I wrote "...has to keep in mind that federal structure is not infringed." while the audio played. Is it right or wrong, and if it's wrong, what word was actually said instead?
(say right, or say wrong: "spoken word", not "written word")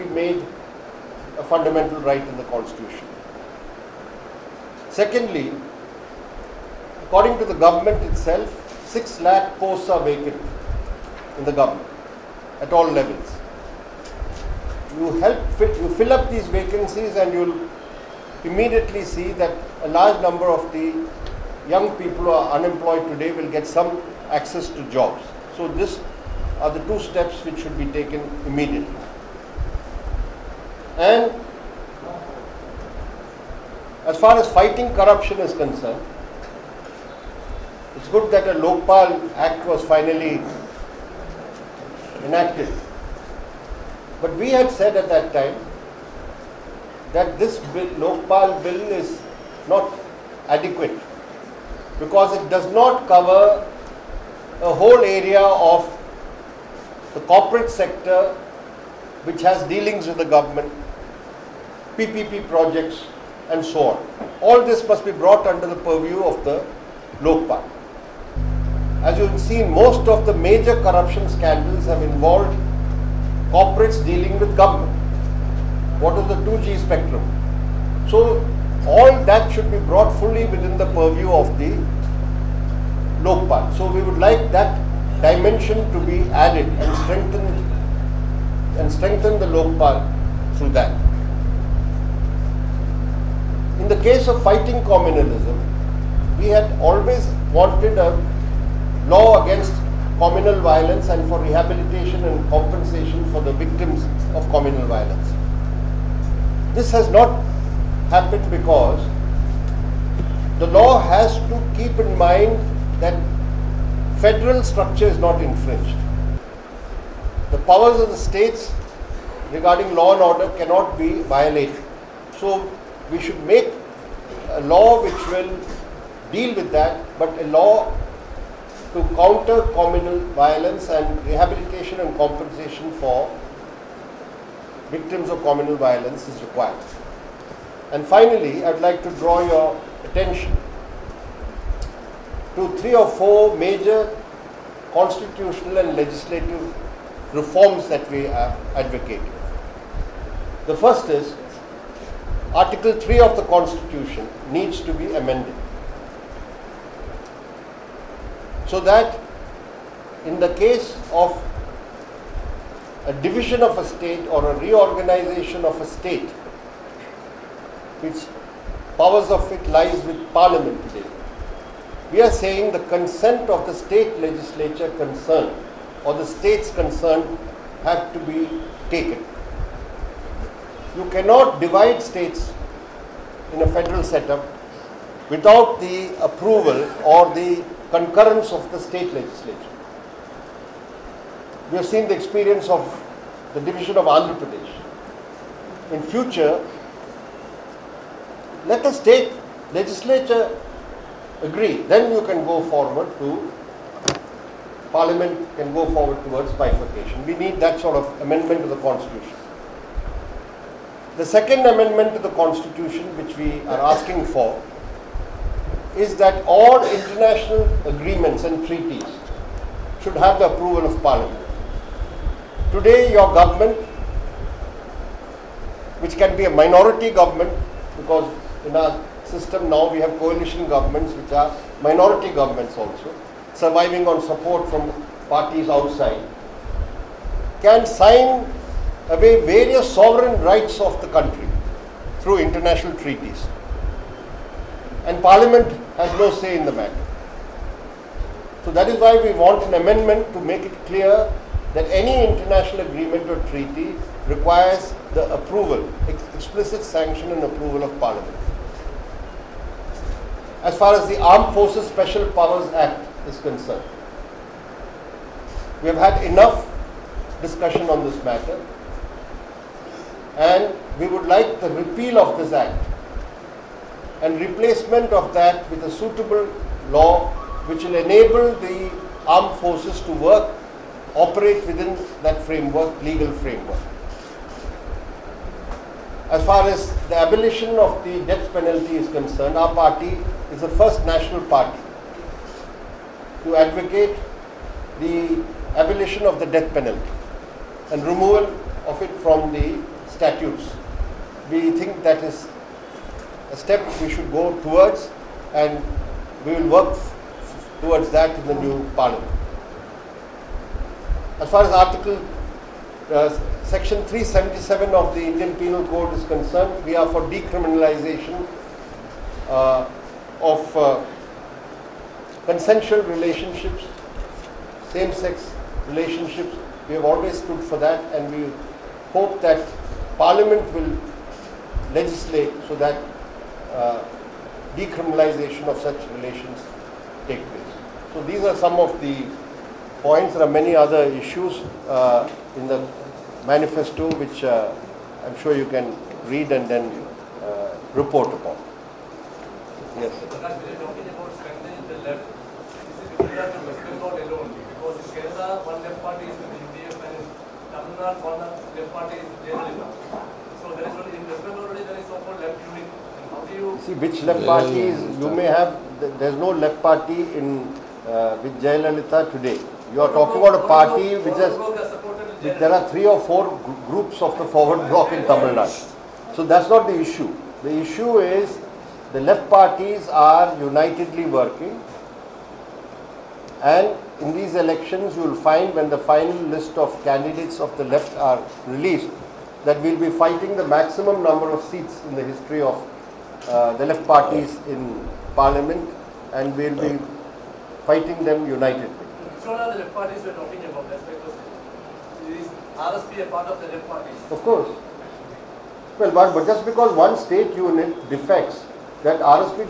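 right.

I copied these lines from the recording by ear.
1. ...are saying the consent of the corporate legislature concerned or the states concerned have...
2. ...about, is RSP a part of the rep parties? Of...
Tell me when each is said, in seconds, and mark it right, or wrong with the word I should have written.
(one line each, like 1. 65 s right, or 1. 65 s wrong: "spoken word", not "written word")
1. 172 s wrong: "state", not "corporate"
2. 400 s right.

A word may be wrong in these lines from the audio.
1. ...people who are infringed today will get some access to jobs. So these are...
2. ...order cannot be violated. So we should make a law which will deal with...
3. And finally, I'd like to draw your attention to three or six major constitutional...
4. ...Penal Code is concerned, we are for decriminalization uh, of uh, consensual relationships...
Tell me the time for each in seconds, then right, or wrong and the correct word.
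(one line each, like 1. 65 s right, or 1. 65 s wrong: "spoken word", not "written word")
1. 21 s wrong: "unemployed", not "infringed"
2. 120 s right
3. 137 s wrong: "four", not "six"
4. 315 s right.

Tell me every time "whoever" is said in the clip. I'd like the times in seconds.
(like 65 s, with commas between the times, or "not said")
not said.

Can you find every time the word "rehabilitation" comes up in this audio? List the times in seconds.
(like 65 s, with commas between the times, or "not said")
101 s, 131 s.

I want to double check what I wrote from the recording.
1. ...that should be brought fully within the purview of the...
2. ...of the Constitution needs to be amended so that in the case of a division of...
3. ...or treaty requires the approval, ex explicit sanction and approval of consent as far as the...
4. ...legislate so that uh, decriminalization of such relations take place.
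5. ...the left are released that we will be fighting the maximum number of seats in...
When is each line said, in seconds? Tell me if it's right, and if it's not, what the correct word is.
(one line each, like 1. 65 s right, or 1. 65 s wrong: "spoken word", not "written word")
1. 79 s right
2. 153 s right
3. 253 s wrong: "parliament", not "consent"
4. 331 s right
5. 387 s right.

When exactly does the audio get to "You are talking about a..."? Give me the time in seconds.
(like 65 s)
369 s.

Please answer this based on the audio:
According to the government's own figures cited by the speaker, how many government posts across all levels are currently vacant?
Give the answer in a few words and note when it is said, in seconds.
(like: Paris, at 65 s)
6 lakh, at 8 s.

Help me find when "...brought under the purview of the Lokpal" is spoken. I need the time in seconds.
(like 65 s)
65 s.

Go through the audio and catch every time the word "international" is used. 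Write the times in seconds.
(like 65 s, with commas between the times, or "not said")
216 s, 242 s, 252 s.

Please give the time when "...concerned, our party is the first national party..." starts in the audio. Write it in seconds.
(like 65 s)
289 s.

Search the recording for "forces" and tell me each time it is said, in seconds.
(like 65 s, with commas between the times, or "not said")
261 s, 279 s.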